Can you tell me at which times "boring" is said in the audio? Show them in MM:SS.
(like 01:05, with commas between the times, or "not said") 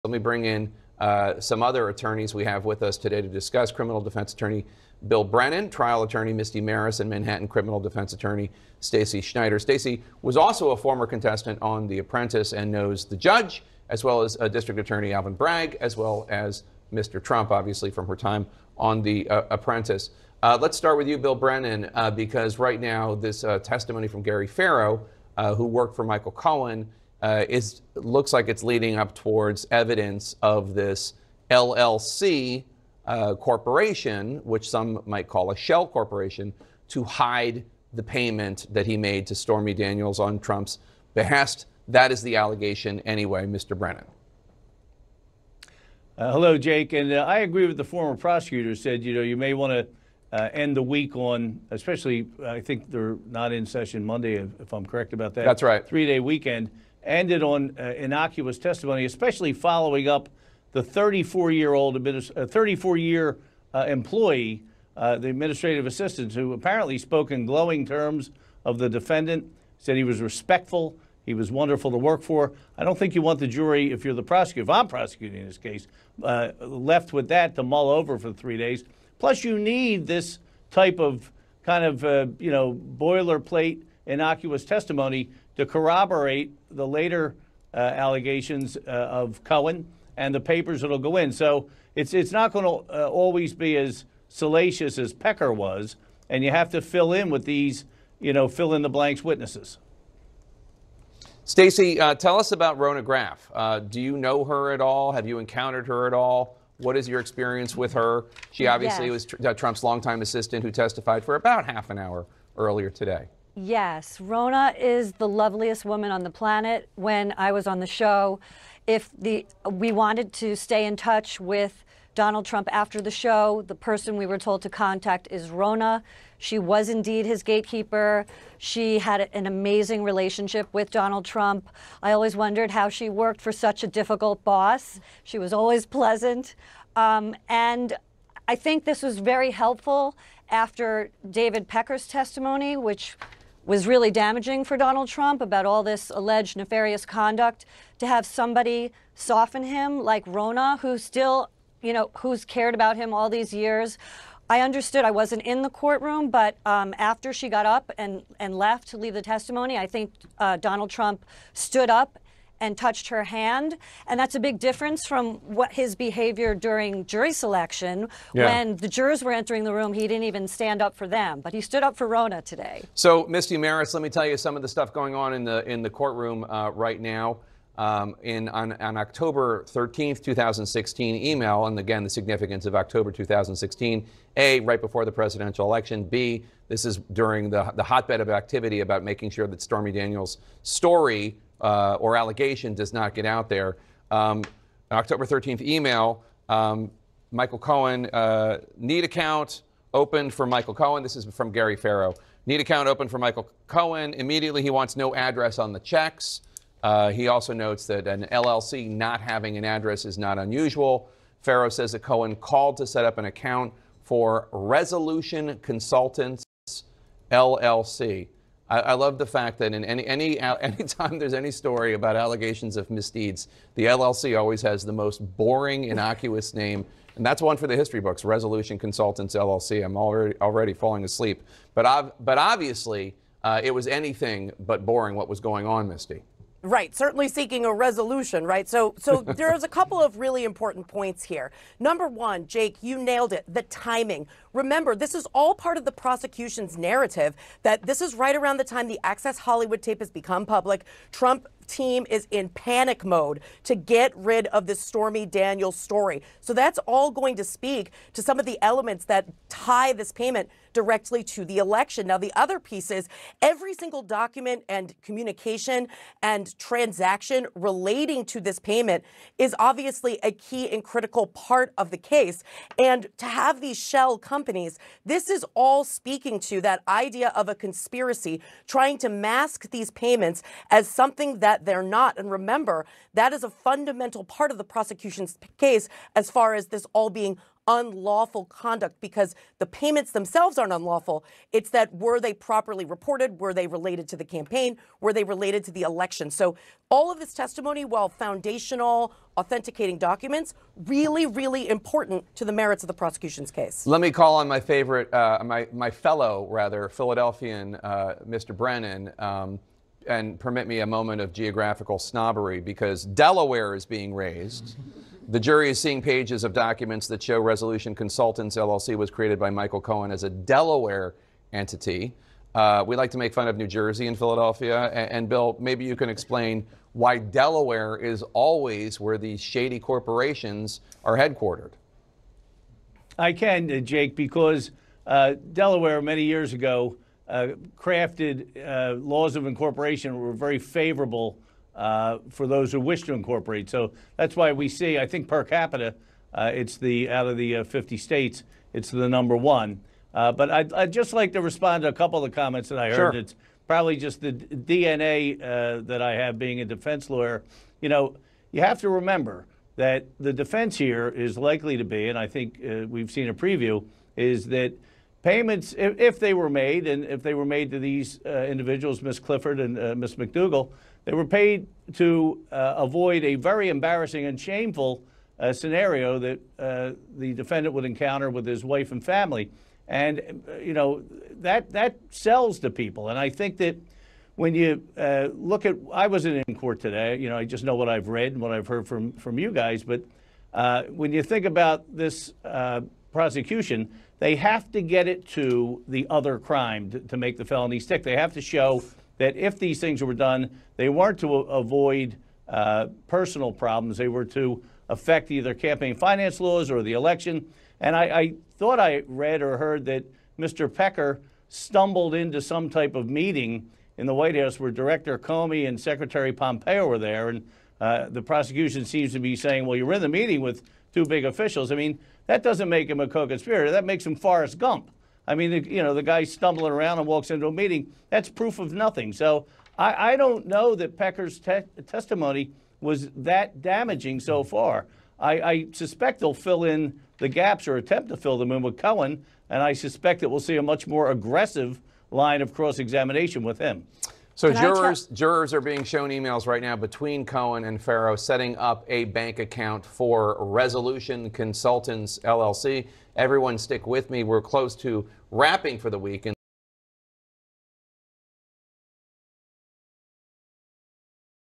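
03:45, 03:54.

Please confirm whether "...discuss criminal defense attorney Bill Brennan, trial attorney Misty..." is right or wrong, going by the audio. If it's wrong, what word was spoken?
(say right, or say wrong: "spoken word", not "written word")
right.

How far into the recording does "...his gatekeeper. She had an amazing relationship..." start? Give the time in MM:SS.
02:07.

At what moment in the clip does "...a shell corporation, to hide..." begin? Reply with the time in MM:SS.
00:35.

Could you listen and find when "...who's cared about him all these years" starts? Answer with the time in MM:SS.
02:32.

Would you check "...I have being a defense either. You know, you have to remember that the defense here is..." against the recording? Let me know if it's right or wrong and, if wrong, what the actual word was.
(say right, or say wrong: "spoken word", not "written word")
wrong: "lawyer", not "either".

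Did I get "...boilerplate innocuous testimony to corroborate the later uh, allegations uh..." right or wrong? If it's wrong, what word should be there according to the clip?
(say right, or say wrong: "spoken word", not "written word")
right.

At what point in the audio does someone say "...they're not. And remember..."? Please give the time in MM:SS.
04:41.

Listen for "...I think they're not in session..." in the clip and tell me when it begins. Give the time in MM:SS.
00:52.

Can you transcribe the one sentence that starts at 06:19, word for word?
And, uh, you know, that, that sells to people.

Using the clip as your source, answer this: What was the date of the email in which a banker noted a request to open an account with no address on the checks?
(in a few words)
October 13, 2016.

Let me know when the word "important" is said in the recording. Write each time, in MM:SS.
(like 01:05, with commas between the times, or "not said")
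04:00, 05:01.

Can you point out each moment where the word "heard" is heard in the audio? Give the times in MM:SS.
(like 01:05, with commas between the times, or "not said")
05:52, 06:28, 06:49.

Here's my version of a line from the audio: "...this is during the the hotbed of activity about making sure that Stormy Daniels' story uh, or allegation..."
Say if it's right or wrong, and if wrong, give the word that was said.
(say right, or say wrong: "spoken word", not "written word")
right.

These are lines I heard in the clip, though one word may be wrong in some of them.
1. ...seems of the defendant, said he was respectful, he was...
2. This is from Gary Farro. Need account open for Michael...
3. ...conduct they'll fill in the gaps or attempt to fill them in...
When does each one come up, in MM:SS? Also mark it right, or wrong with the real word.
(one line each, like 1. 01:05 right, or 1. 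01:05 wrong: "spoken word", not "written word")
1. 01:07 wrong: "terms", not "seems"
2. 03:21 right
3. 07:15 wrong: "suspect", not "conduct".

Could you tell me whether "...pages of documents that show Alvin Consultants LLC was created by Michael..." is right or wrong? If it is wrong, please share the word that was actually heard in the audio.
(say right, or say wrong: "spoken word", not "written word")
wrong: "Resolution", not "Alvin".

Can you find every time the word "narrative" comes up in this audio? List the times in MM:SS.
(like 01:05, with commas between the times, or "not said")
04:06.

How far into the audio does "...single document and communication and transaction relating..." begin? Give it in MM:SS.
04:23.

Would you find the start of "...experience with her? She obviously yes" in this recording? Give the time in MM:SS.
01:47.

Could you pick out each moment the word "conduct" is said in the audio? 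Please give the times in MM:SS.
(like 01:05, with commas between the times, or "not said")
02:27, 04:48.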